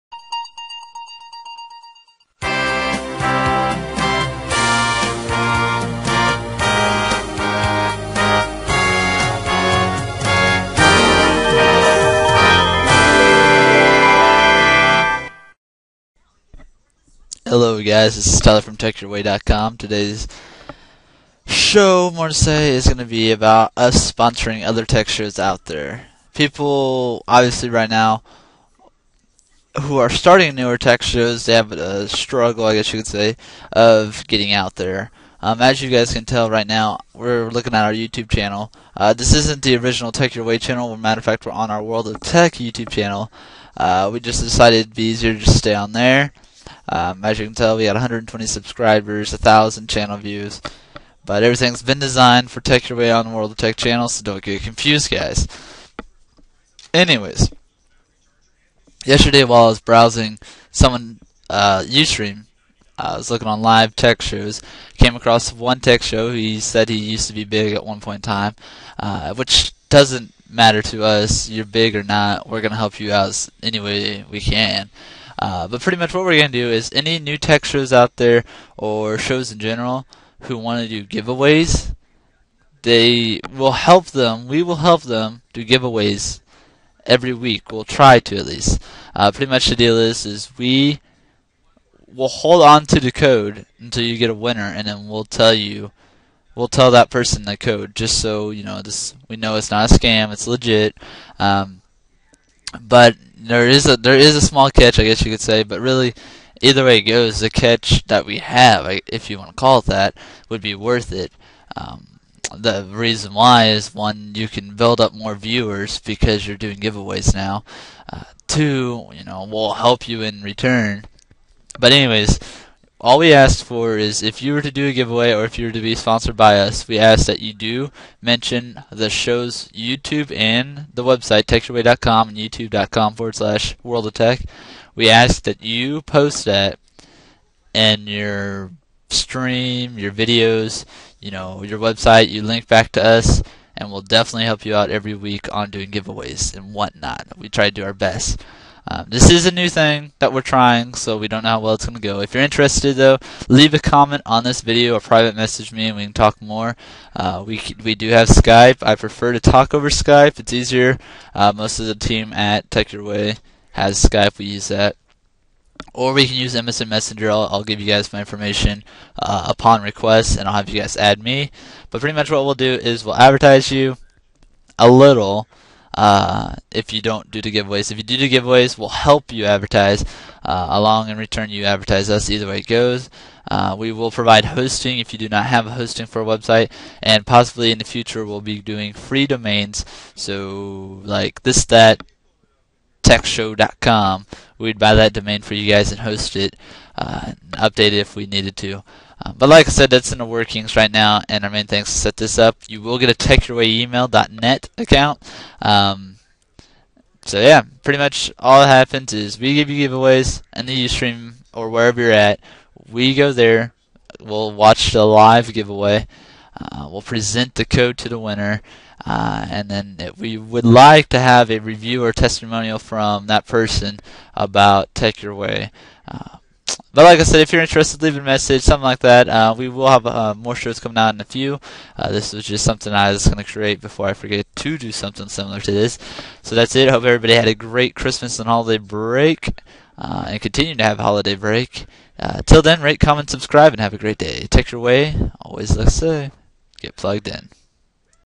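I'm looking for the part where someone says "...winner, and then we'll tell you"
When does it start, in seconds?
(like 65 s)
94 s.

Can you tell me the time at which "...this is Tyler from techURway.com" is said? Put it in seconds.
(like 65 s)
18 s.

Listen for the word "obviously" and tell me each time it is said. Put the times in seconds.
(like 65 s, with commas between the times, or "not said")
27 s.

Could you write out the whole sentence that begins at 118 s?
Uh, two, you know, will help you in return.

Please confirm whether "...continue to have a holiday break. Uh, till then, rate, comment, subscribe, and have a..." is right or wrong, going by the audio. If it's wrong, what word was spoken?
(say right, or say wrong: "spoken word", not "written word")
right.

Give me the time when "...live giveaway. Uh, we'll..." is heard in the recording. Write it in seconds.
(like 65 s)
215 s.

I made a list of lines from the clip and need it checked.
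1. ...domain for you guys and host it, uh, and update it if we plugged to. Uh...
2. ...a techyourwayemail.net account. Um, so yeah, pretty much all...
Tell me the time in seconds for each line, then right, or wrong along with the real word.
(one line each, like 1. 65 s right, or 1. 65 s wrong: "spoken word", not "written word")
1. 195 s wrong: "needed", not "plugged"
2. 203 s right.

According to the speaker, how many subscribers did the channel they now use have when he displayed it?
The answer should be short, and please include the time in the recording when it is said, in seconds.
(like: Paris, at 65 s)
120, at 47 s.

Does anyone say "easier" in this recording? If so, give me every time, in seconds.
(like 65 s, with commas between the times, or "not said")
45 s, 160 s.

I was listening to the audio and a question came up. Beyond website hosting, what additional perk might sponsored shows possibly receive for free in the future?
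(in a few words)
Free domains.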